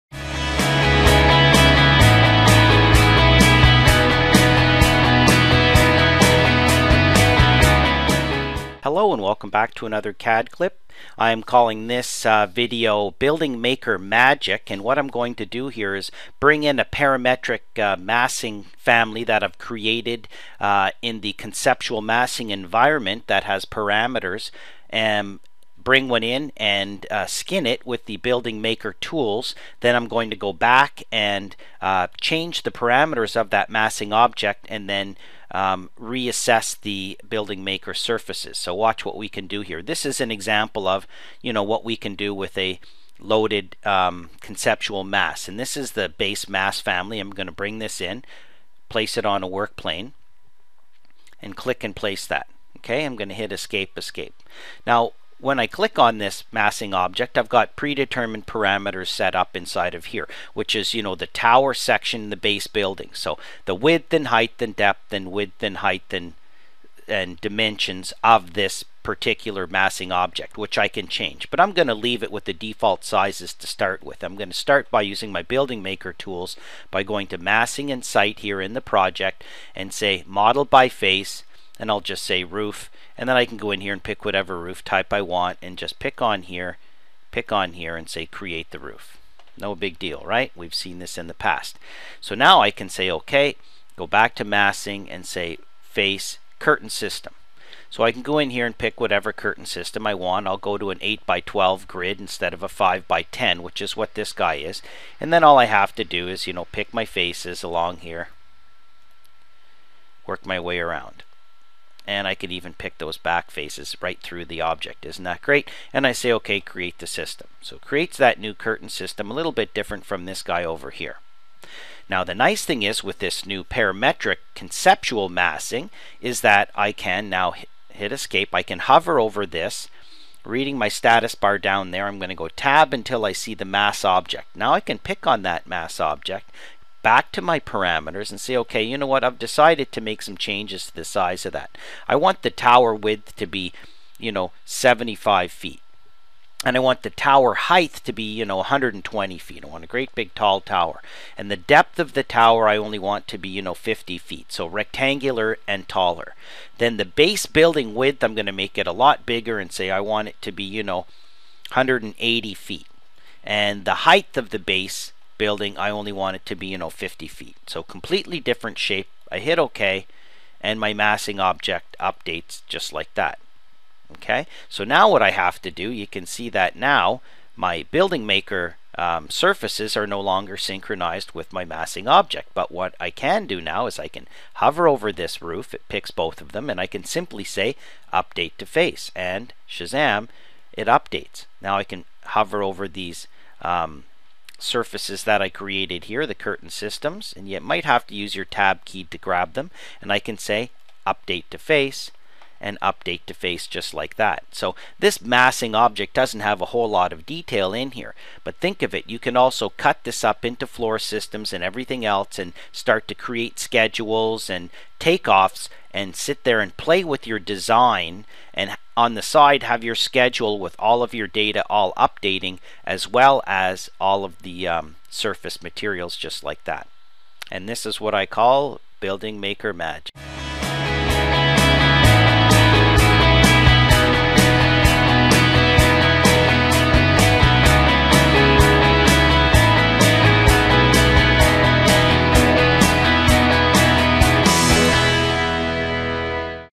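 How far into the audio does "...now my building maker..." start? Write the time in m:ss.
2:56.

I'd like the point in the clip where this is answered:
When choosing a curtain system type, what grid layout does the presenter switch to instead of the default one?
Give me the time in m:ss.
1:41.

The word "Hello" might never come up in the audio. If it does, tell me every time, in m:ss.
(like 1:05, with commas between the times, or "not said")
0:08.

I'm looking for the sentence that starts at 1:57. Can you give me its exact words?
So creates that new curtain system, a little bit different from this guy over here.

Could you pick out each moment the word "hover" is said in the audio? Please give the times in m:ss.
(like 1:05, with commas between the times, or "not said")
2:08, 3:04, 3:12.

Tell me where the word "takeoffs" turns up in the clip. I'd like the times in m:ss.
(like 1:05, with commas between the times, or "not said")
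3:34.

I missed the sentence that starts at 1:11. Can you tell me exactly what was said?
But I'm going to leave it with the default sizes to start with.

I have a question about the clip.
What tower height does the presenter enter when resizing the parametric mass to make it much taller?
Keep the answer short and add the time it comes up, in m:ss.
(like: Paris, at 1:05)
120 feet, at 2:28.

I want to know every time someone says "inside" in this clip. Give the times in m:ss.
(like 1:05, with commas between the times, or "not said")
0:59.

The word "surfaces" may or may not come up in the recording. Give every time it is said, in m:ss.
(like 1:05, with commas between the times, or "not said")
0:37, 2:59, 3:14, 3:45.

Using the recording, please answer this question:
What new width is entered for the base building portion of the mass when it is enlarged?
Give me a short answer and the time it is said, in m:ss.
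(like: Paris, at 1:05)
180 feet, at 2:41.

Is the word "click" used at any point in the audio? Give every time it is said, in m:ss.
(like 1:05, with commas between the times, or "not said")
0:51, 0:55.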